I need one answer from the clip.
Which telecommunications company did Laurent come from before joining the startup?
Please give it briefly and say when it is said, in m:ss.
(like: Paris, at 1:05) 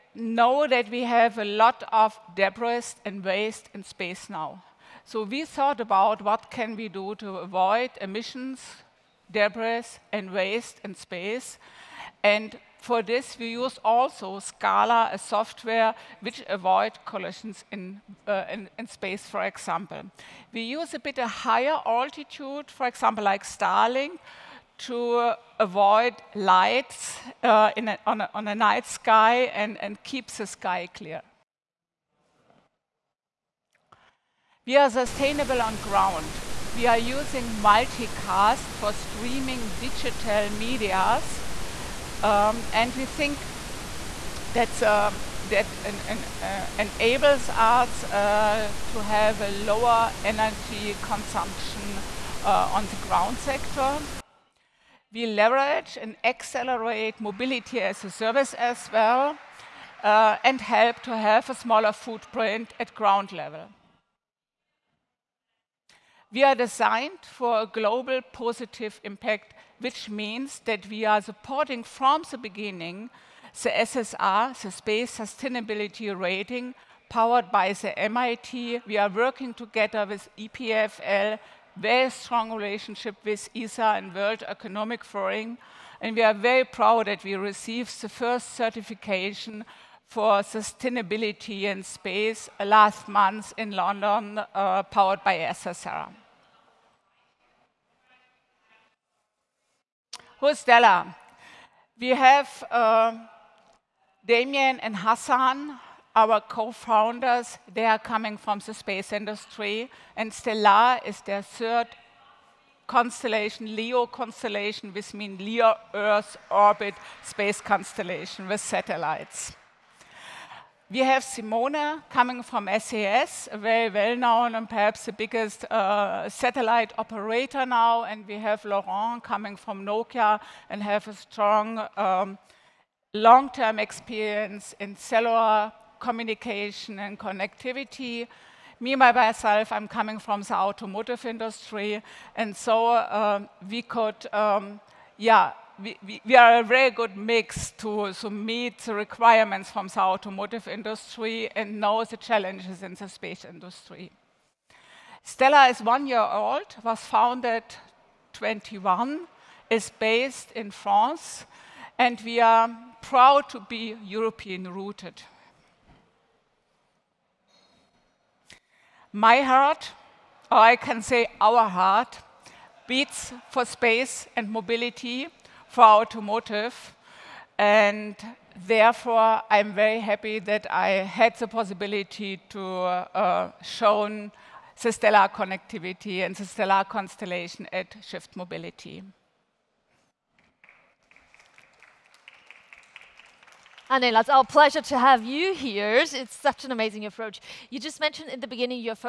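Nokia, at 2:09.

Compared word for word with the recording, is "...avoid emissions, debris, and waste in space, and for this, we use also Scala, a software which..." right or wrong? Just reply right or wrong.
right.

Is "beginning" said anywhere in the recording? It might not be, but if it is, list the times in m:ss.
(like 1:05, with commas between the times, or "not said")
1:12, 3:18.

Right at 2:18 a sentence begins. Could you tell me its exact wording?
Me, myself, I'm coming from the automotive industry.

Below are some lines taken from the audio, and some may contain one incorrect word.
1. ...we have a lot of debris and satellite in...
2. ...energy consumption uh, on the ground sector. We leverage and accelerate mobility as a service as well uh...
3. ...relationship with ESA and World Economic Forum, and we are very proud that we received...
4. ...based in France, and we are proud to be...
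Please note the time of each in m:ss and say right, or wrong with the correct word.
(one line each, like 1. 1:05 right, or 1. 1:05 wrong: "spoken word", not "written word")
1. 0:00 wrong: "waste", not "satellite"
2. 0:50 right
3. 1:22 right
4. 2:39 right.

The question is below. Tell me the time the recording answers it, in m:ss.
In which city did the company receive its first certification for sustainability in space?
1:33.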